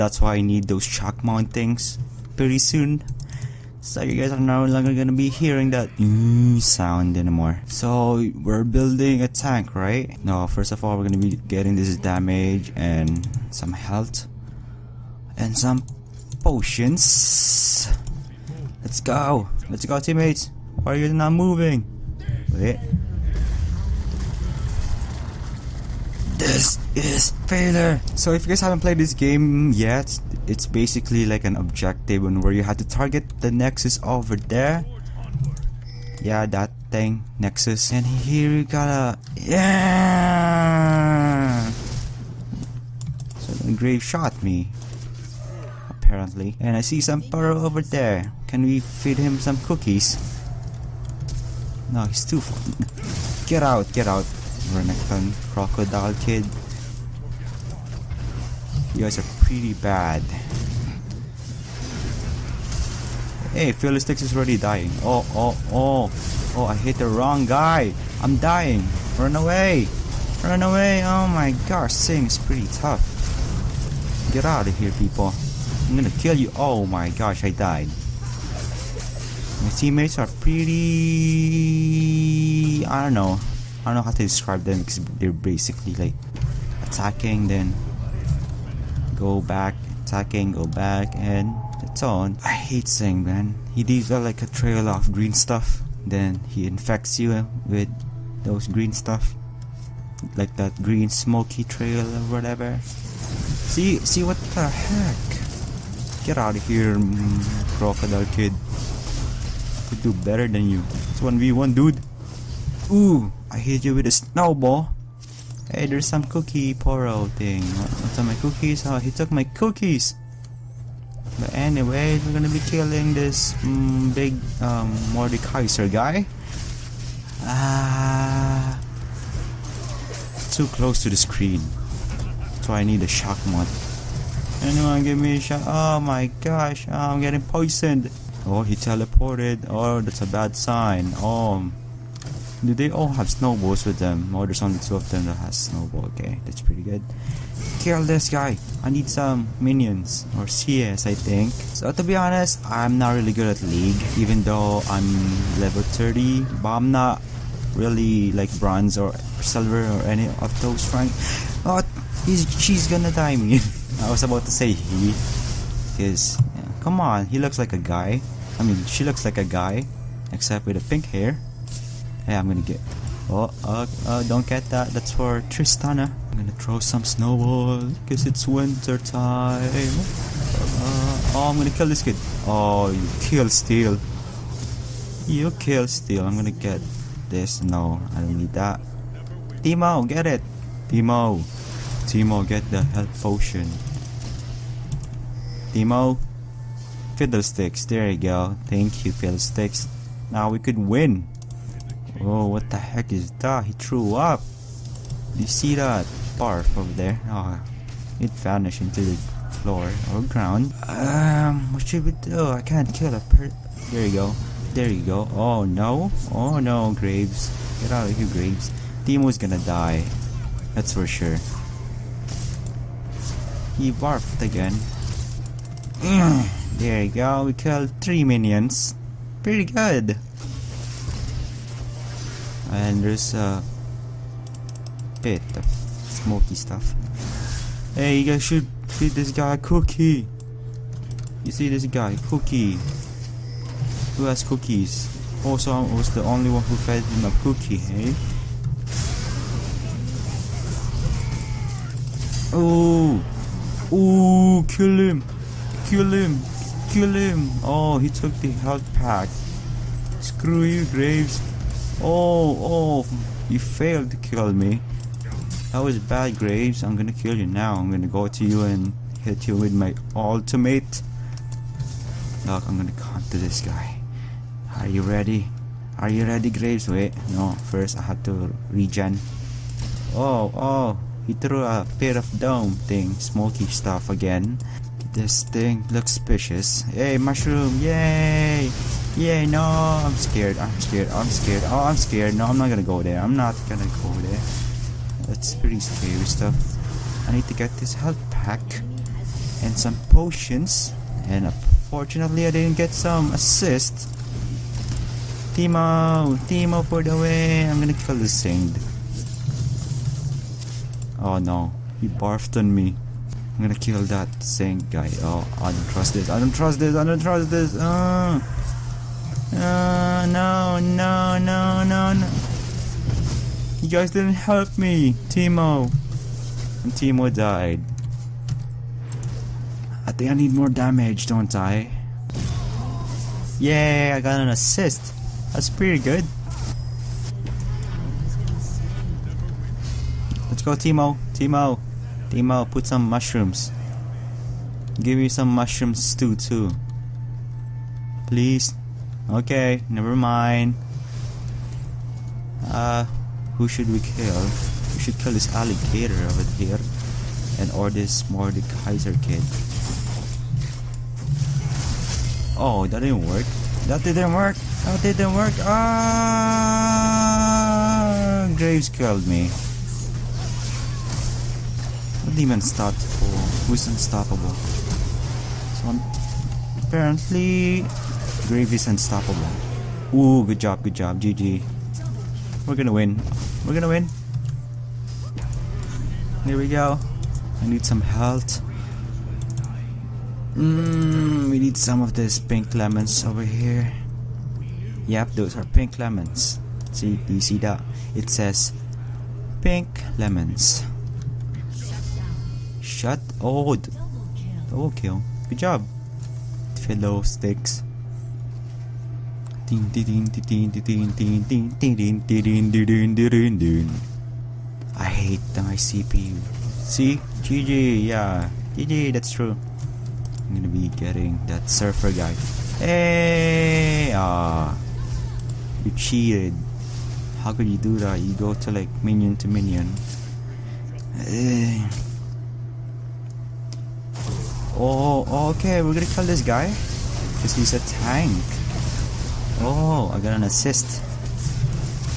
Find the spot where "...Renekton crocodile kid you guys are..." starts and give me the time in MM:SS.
00:54.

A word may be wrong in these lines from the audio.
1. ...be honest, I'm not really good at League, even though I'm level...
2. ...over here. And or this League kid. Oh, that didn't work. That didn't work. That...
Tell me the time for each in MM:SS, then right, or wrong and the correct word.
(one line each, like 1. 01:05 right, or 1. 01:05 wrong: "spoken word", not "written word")
1. 02:32 right
2. 05:56 wrong: "Mordekaiser", not "League".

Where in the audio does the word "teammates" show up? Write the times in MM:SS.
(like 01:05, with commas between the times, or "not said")
00:19, 01:19.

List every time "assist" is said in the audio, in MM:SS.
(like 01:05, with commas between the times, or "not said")
05:03, 05:34, 07:20.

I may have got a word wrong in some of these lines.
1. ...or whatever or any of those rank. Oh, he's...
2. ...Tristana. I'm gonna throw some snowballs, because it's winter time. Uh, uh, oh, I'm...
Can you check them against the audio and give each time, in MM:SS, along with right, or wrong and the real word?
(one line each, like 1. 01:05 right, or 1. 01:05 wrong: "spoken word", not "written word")
1. 02:38 wrong: "silver", not "whatever"
2. 02:55 right.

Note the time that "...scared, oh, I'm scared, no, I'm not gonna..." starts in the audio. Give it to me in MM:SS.
04:51.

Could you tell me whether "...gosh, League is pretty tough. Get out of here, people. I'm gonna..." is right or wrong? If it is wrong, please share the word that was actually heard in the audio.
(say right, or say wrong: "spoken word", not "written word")
wrong: "Sing", not "League".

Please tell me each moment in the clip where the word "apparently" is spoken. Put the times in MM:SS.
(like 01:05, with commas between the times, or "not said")
00:45, 06:16.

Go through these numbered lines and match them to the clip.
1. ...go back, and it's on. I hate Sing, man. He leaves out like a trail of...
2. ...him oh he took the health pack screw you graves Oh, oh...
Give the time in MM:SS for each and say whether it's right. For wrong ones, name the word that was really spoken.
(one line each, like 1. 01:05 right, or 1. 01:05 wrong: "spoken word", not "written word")
1. 01:30 right
2. 04:17 right.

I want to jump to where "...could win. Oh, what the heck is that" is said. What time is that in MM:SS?
03:20.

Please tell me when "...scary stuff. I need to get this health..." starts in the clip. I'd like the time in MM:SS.
04:55.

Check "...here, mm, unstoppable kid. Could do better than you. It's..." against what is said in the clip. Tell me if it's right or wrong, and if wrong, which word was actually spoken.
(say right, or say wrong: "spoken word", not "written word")
wrong: "crocodile", not "unstoppable".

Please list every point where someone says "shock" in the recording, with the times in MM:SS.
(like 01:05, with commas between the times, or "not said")
00:00, 02:13.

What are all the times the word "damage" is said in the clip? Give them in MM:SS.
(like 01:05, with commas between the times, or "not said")
00:11, 05:30.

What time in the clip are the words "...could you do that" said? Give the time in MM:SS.
07:07.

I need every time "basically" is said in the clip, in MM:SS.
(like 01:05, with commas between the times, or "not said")
00:30, 01:25.